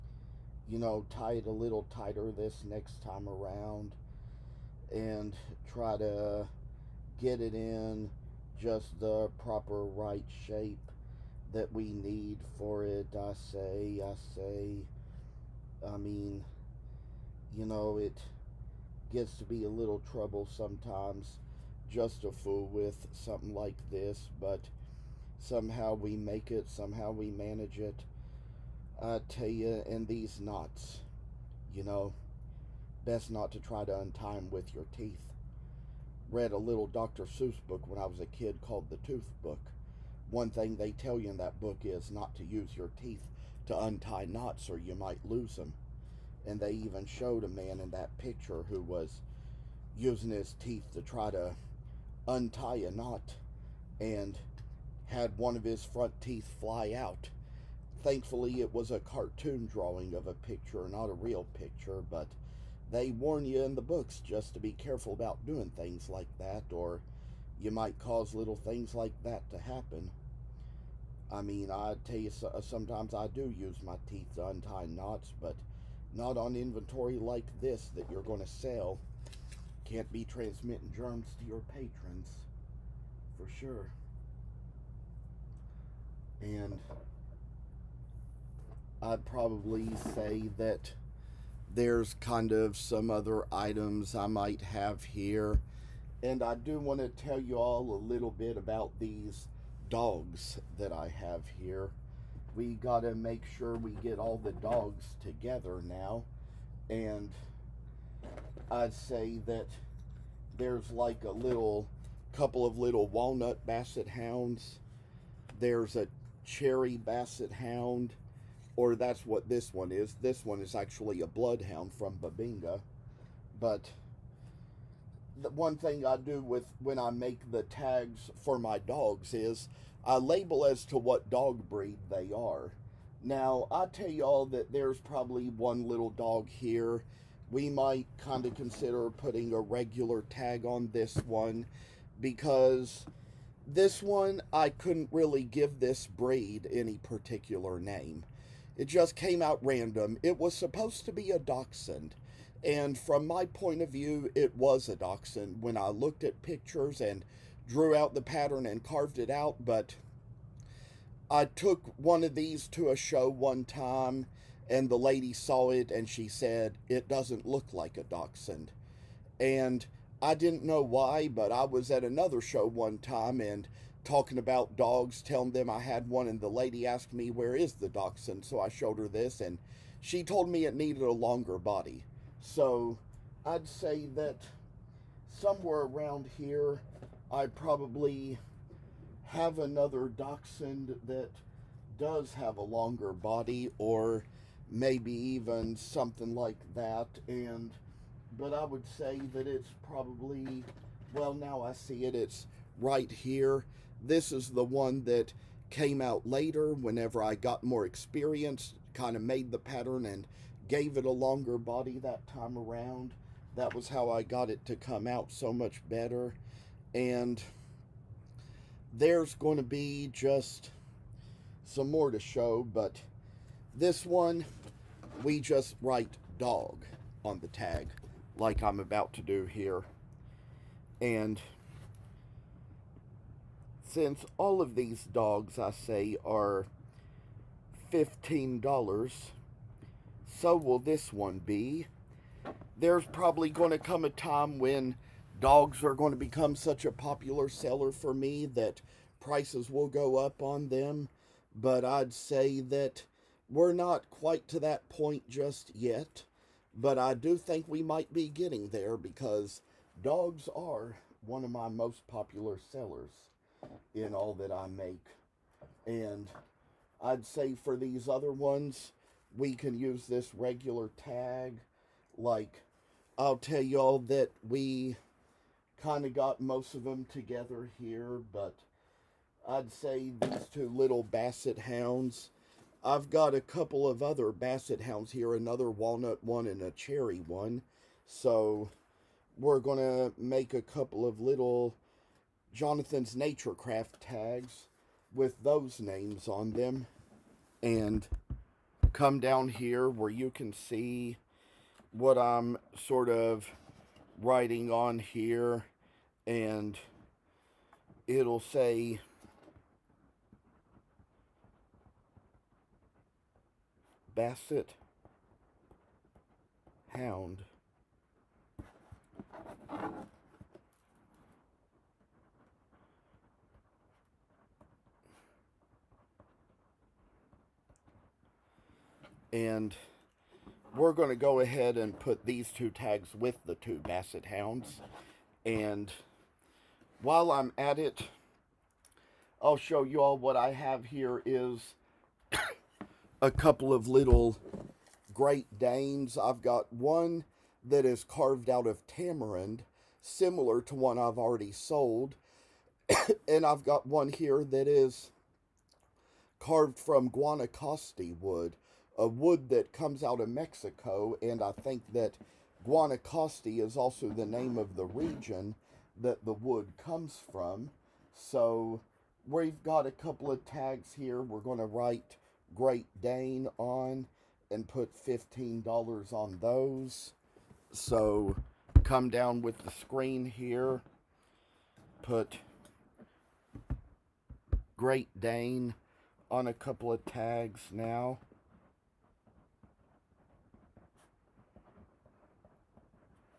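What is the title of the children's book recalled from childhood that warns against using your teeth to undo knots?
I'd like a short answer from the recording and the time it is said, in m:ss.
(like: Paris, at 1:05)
The Tooth Book, at 0:38.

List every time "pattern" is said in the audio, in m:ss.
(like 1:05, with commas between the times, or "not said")
2:38, 3:29.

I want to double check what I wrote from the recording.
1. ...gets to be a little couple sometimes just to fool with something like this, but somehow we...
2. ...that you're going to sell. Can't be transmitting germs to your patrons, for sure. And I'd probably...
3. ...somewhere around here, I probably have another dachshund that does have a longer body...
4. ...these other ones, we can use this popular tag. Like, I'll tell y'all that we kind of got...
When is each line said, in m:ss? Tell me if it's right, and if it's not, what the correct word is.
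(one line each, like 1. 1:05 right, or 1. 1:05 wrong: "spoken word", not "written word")
1. 0:19 wrong: "trouble", not "couple"
2. 1:17 right
3. 3:05 right
4. 4:27 wrong: "regular", not "popular".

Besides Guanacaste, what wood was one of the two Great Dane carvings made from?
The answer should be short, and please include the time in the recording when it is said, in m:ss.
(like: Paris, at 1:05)
Tamarind, at 5:48.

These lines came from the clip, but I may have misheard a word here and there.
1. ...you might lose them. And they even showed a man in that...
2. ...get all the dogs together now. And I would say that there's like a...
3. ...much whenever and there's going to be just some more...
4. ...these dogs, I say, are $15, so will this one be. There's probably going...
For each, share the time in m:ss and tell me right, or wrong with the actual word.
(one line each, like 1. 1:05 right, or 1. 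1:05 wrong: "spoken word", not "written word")
1. 0:44 right
2. 1:44 right
3. 3:35 wrong: "better", not "whenever"
4. 3:54 right.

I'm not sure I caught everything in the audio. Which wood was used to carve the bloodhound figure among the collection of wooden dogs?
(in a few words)
Bubinga.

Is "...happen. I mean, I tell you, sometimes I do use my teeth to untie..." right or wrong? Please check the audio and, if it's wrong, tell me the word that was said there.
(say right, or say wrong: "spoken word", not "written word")
right.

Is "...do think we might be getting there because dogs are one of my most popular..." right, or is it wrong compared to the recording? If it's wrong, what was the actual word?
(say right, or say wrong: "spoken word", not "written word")
right.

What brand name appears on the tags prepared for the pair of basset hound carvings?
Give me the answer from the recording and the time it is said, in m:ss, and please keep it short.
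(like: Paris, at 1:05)
Jonathan's Nature Craft, at 4:52.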